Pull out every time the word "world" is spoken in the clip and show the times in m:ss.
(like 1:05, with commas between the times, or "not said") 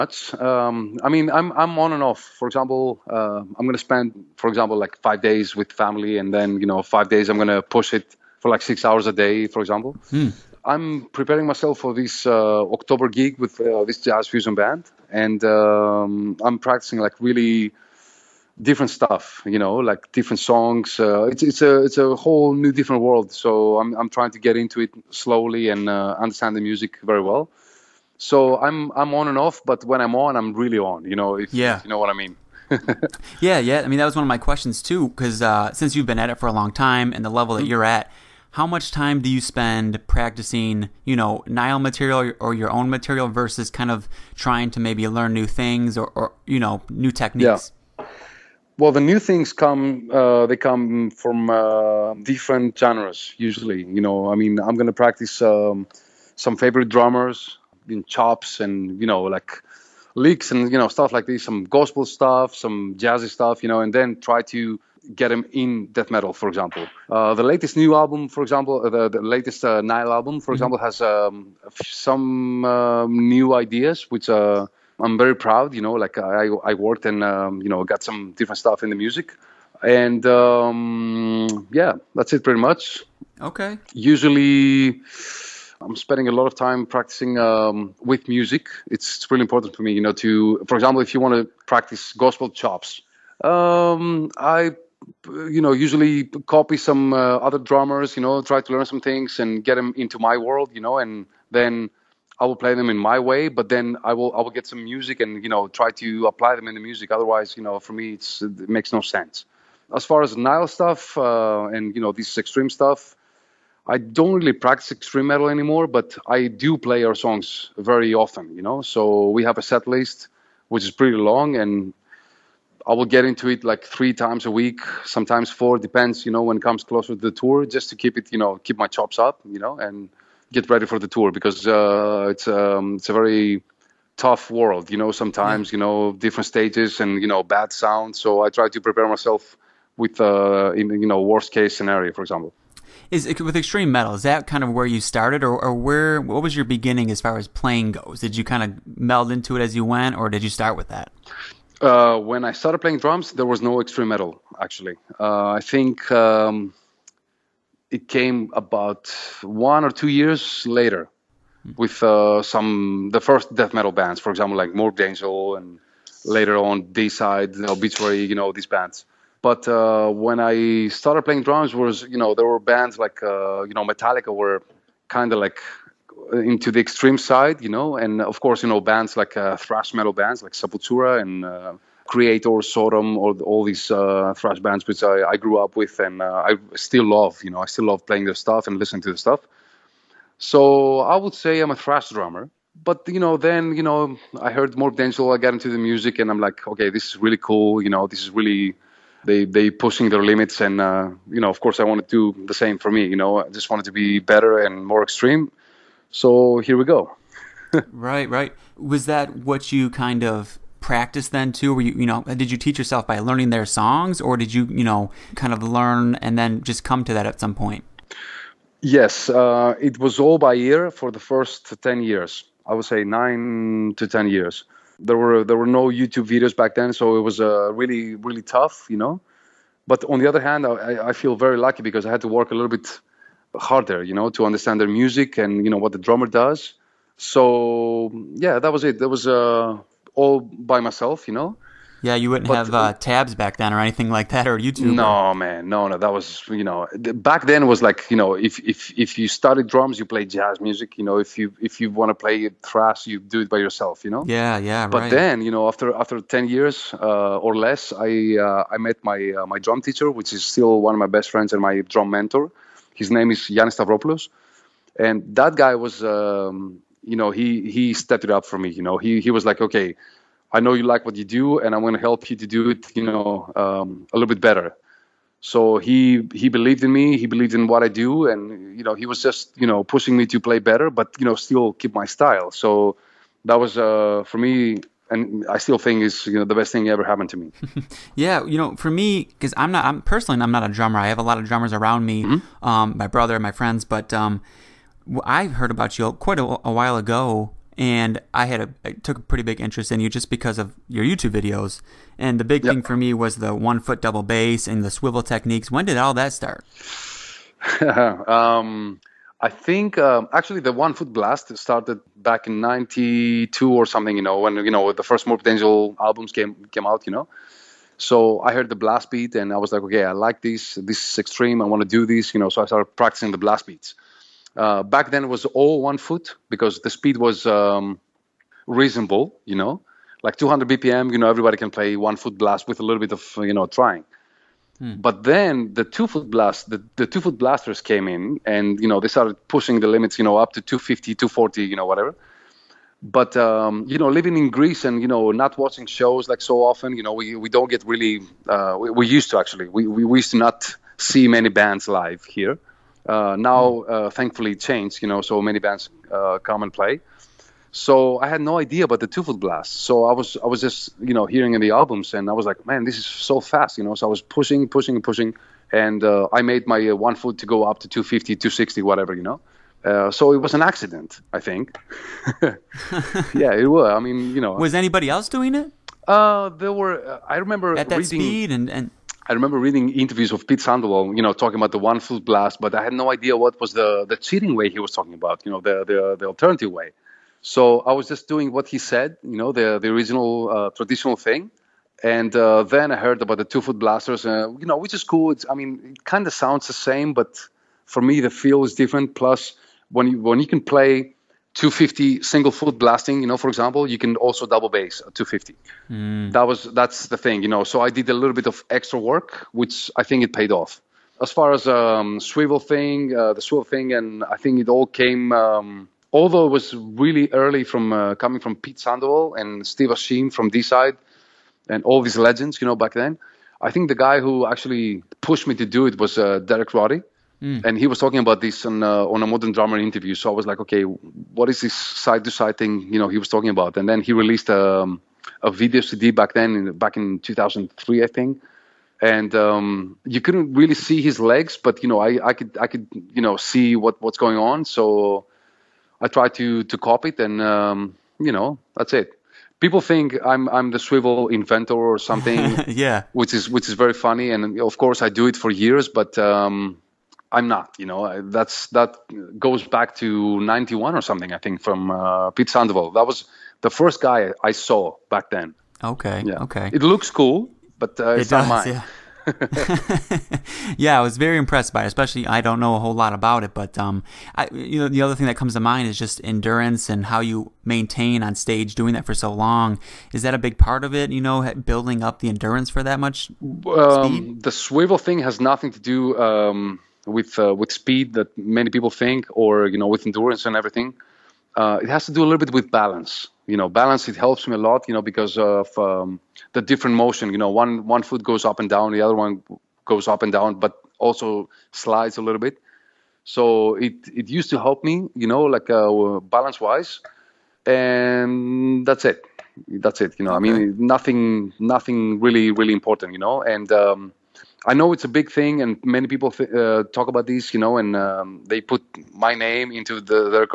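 0:23, 1:40, 2:14.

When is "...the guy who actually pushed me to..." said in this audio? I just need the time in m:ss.
7:03.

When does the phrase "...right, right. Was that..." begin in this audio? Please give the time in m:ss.
3:27.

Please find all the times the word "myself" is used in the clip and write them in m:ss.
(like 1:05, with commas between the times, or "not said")
0:11, 2:19, 4:00.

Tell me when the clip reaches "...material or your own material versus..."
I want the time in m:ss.
0:41.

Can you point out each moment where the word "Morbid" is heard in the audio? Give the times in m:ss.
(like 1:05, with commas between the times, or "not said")
2:44, 5:15.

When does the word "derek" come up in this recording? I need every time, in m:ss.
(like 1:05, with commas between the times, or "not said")
7:06.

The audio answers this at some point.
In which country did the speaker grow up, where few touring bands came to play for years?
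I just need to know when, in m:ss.
5:44.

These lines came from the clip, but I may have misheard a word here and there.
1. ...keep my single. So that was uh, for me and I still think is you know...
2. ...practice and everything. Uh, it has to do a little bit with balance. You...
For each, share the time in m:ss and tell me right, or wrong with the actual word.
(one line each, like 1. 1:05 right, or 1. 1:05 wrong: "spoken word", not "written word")
1. 4:41 wrong: "style", not "single"
2. 8:10 wrong: "endurance", not "practice".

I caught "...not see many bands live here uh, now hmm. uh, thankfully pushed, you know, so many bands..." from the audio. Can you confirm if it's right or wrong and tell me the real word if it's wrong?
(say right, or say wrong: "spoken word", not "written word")
wrong: "changed", not "pushed".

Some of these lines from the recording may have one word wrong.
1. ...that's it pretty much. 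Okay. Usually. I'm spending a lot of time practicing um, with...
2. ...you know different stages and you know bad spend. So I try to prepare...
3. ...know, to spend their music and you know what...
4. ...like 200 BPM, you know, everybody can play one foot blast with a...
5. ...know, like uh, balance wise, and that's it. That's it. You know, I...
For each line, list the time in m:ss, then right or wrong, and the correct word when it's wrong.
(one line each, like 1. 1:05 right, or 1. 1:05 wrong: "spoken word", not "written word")
1. 1:22 right
2. 2:15 wrong: "sound", not "spend"
3. 3:54 wrong: "understand", not "spend"
4. 5:30 right
5. 8:25 right.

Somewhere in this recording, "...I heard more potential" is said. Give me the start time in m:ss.
3:14.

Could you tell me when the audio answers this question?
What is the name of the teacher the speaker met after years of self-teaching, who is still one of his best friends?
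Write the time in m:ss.
4:23.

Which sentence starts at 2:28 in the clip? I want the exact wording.
Did you kind of meld into it as you went, or did you start with that?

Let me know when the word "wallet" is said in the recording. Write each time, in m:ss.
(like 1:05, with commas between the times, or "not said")
not said.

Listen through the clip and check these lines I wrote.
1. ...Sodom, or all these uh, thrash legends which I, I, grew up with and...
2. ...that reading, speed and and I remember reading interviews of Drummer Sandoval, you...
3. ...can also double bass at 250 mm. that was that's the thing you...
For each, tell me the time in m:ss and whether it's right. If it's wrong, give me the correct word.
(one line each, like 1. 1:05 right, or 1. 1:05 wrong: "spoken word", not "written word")
1. 3:02 wrong: "bands", not "legends"
2. 6:17 wrong: "Pete", not "Drummer"
3. 6:43 right.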